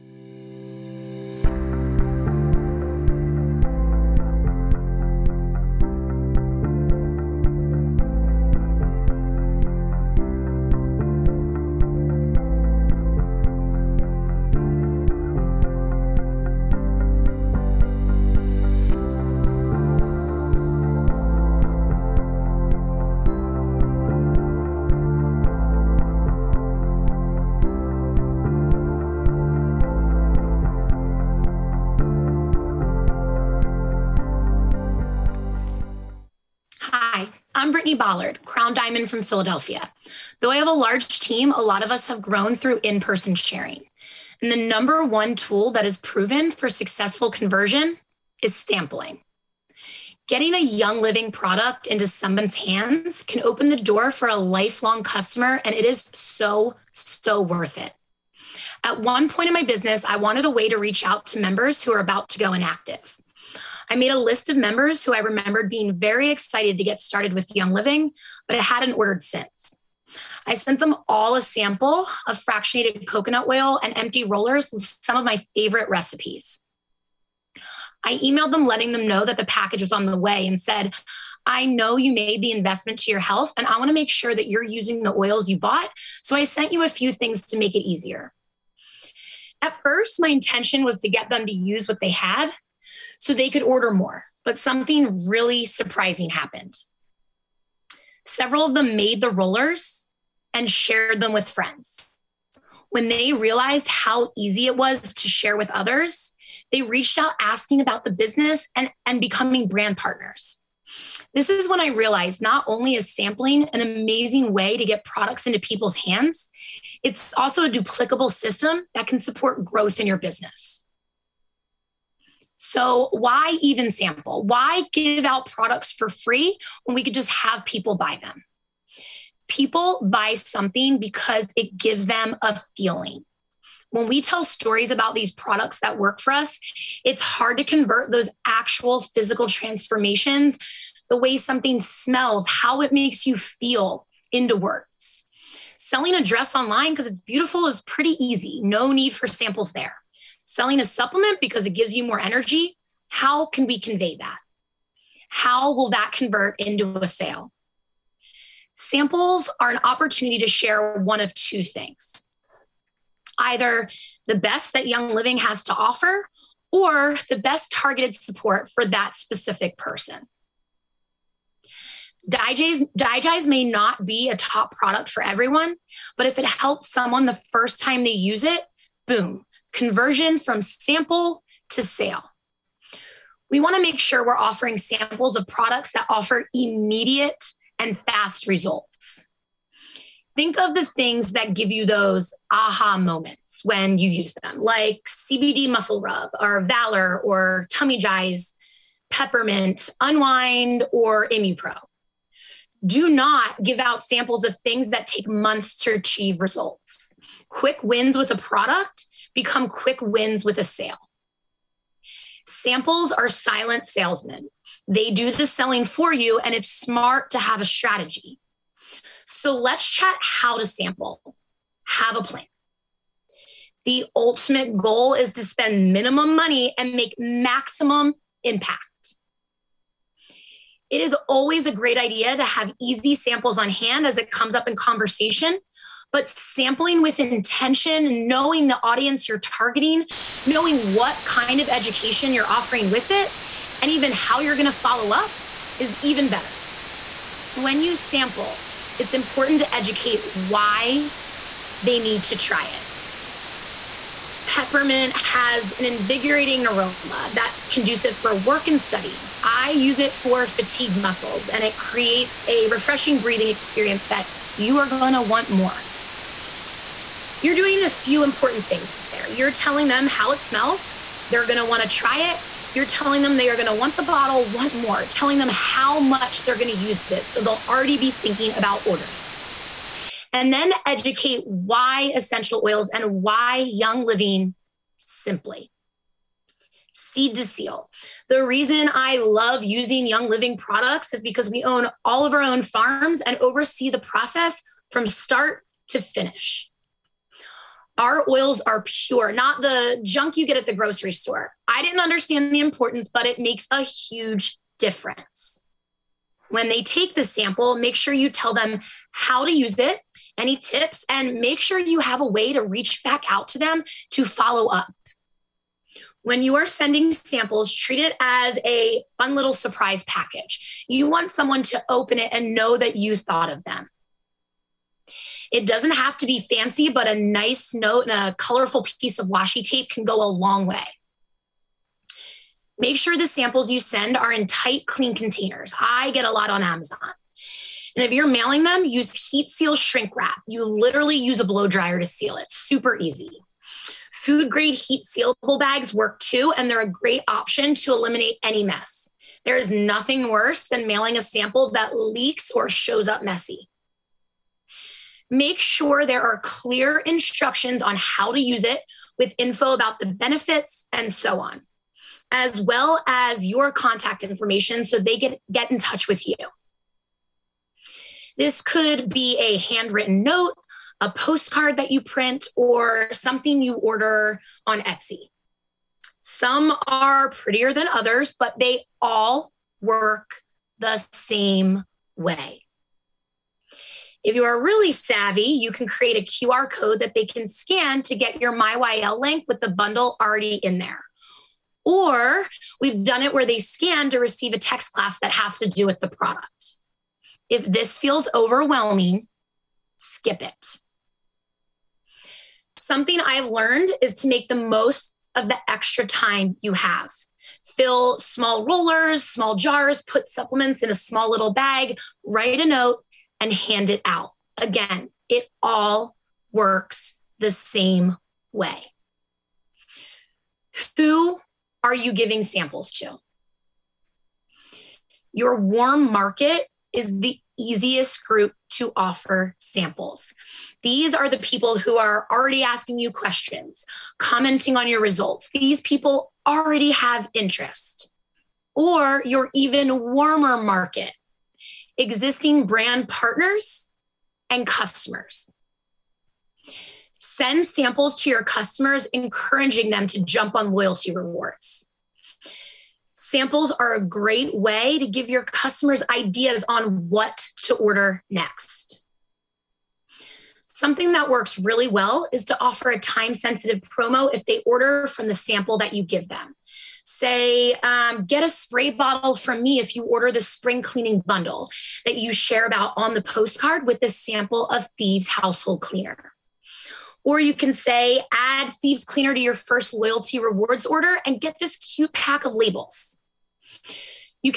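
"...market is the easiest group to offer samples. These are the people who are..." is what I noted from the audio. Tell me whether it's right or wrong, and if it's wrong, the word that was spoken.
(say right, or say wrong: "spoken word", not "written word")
right.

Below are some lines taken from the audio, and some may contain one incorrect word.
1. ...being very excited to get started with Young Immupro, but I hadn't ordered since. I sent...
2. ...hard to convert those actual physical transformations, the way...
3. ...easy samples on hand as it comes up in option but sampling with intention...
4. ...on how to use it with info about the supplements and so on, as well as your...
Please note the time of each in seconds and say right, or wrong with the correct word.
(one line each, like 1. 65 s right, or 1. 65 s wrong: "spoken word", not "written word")
1. 65 s wrong: "Living", not "Immupro"
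2. 137 s right
3. 232 s wrong: "conversation", not "option"
4. 357 s wrong: "benefits", not "supplements".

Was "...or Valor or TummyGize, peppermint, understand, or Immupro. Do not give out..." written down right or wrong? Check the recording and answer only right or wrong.
wrong.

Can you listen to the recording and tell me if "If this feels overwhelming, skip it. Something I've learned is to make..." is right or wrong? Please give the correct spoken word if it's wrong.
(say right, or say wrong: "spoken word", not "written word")
right.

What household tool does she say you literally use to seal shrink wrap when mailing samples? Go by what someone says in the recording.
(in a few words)
blow dryer.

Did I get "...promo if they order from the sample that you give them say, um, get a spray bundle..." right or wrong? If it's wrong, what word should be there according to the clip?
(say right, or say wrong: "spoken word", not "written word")
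wrong: "bottle", not "bundle".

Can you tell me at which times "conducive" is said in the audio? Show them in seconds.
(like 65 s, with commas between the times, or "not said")
257 s.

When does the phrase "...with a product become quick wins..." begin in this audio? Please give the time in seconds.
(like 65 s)
208 s.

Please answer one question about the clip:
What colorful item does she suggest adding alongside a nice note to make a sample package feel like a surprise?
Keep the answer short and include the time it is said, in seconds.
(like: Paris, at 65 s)
washi tape, at 329 s.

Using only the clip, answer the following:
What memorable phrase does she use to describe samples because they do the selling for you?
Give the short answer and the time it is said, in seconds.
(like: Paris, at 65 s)
silent salesmen, at 213 s.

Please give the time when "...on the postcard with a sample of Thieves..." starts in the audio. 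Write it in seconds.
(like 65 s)
472 s.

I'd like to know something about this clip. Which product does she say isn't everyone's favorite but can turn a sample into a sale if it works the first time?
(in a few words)
DiGize.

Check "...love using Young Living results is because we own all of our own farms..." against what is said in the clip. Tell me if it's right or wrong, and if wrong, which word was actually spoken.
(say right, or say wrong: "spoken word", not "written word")
wrong: "products", not "results".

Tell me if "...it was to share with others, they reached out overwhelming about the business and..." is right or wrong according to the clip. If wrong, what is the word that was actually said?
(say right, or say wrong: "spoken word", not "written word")
wrong: "asking", not "overwhelming".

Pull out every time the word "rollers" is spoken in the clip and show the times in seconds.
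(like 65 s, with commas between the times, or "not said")
74 s, 99 s, 408 s.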